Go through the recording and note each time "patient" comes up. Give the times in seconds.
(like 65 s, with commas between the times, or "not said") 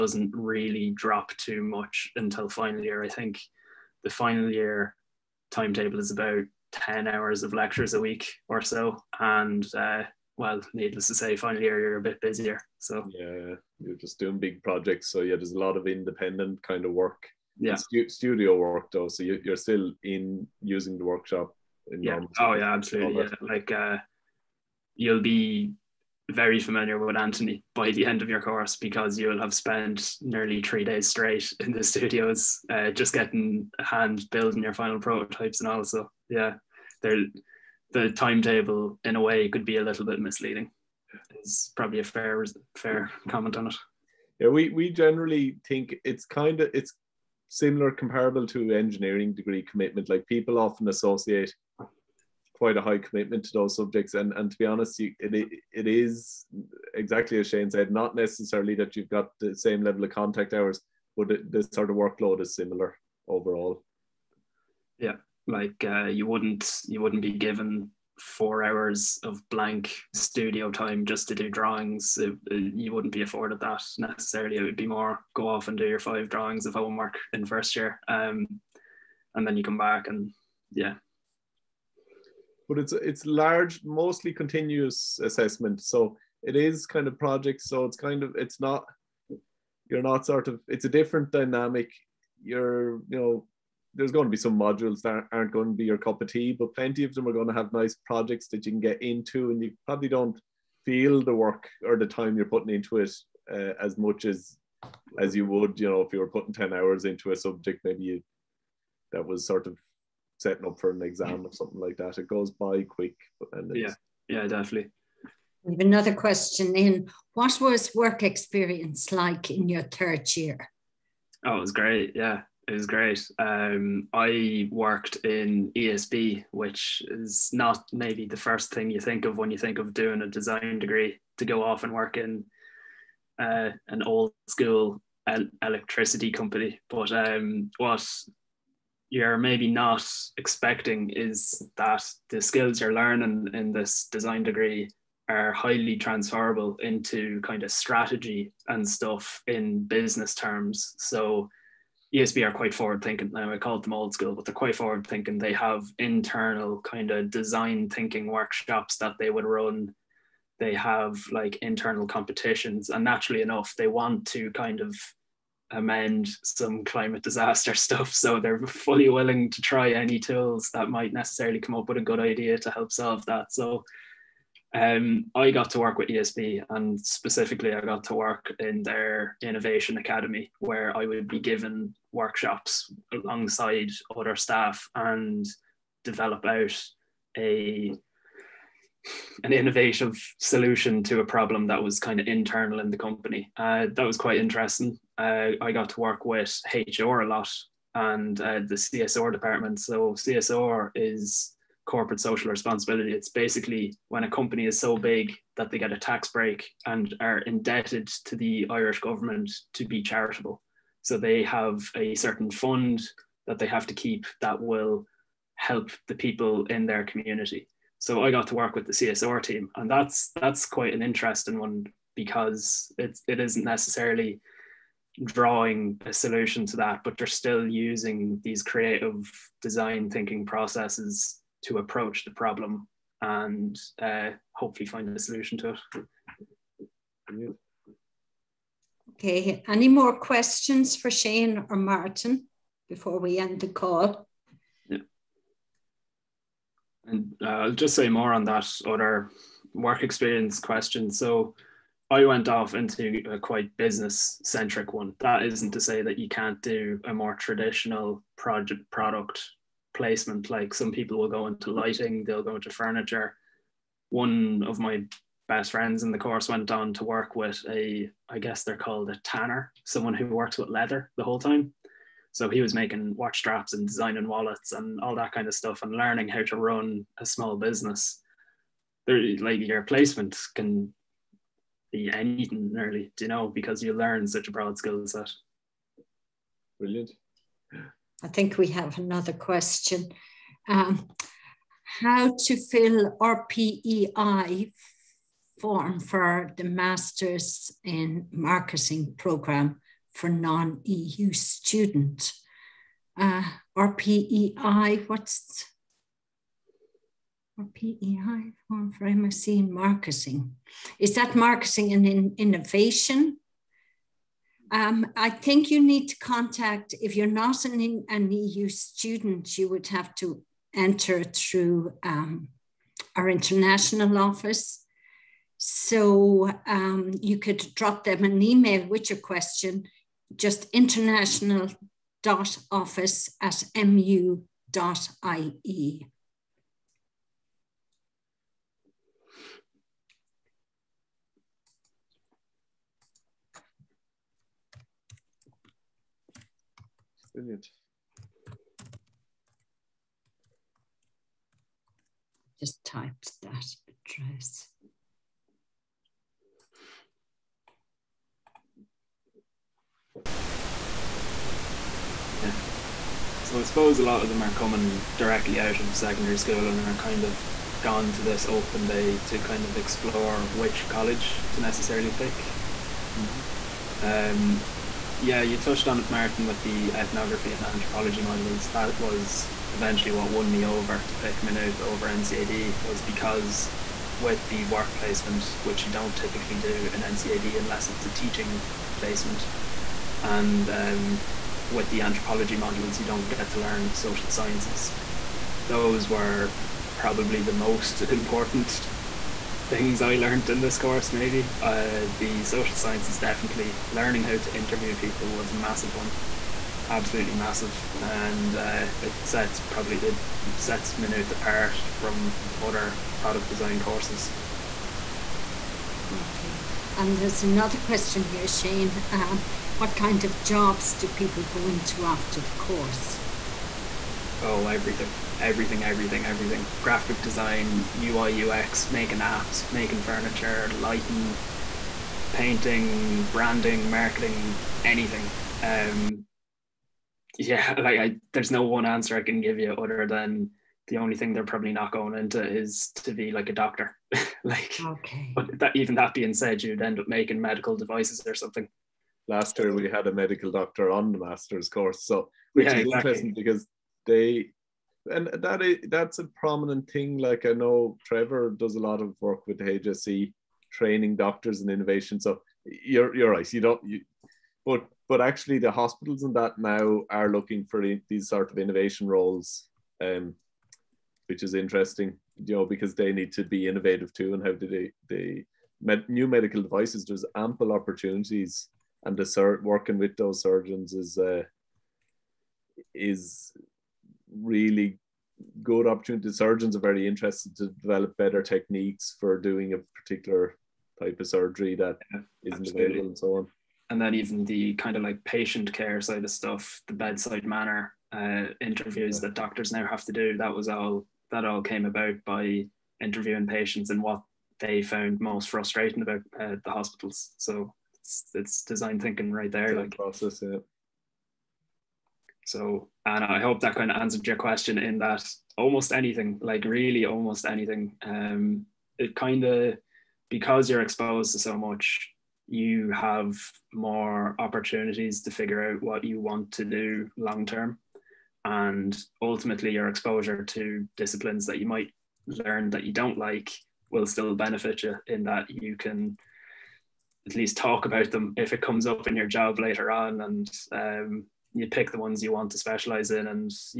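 495 s, 503 s.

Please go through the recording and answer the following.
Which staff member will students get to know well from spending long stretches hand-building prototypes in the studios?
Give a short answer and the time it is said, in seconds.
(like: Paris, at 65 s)
Anthony, at 27 s.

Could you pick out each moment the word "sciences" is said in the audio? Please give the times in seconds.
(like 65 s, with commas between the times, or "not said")
394 s, 402 s.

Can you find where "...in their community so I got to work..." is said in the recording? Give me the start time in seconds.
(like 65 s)
216 s.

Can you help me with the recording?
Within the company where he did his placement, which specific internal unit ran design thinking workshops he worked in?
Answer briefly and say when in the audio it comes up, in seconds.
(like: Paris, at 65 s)
Innovation academy, at 179 s.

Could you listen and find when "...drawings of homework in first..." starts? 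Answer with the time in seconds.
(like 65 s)
76 s.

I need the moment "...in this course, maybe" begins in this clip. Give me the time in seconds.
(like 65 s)
400 s.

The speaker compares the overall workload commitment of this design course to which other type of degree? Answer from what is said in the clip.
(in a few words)
Engineering.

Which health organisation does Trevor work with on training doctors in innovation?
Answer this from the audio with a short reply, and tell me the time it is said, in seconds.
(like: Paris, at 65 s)
HSE, at 459 s.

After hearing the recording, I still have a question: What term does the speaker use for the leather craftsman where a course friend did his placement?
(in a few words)
Tanner.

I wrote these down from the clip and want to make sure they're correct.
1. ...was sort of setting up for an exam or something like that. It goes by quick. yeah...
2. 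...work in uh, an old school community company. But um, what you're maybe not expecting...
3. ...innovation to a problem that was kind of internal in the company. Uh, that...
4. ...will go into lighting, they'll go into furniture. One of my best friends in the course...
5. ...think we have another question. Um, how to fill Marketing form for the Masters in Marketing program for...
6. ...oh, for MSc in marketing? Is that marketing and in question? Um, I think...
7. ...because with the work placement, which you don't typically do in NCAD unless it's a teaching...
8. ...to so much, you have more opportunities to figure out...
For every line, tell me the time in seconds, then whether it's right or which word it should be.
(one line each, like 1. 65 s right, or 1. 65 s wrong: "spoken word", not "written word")
1. 109 s right
2. 131 s wrong: "electricity", not "community"
3. 190 s wrong: "solution", not "innovation"
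4. 261 s right
5. 288 s wrong: "RPEI", not "Marketing"
6. 308 s wrong: "innovation", not "question"
7. 383 s right
8. 521 s right.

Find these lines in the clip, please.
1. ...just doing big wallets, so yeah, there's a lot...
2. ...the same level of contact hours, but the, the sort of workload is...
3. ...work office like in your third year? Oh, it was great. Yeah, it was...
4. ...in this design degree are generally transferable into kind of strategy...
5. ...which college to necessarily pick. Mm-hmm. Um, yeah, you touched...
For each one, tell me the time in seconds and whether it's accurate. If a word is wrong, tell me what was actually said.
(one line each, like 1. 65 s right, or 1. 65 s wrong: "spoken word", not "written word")
1. 13 s wrong: "projects", not "wallets"
2. 59 s right
3. 117 s wrong: "experience", not "office"
4. 143 s wrong: "highly", not "generally"
5. 370 s right.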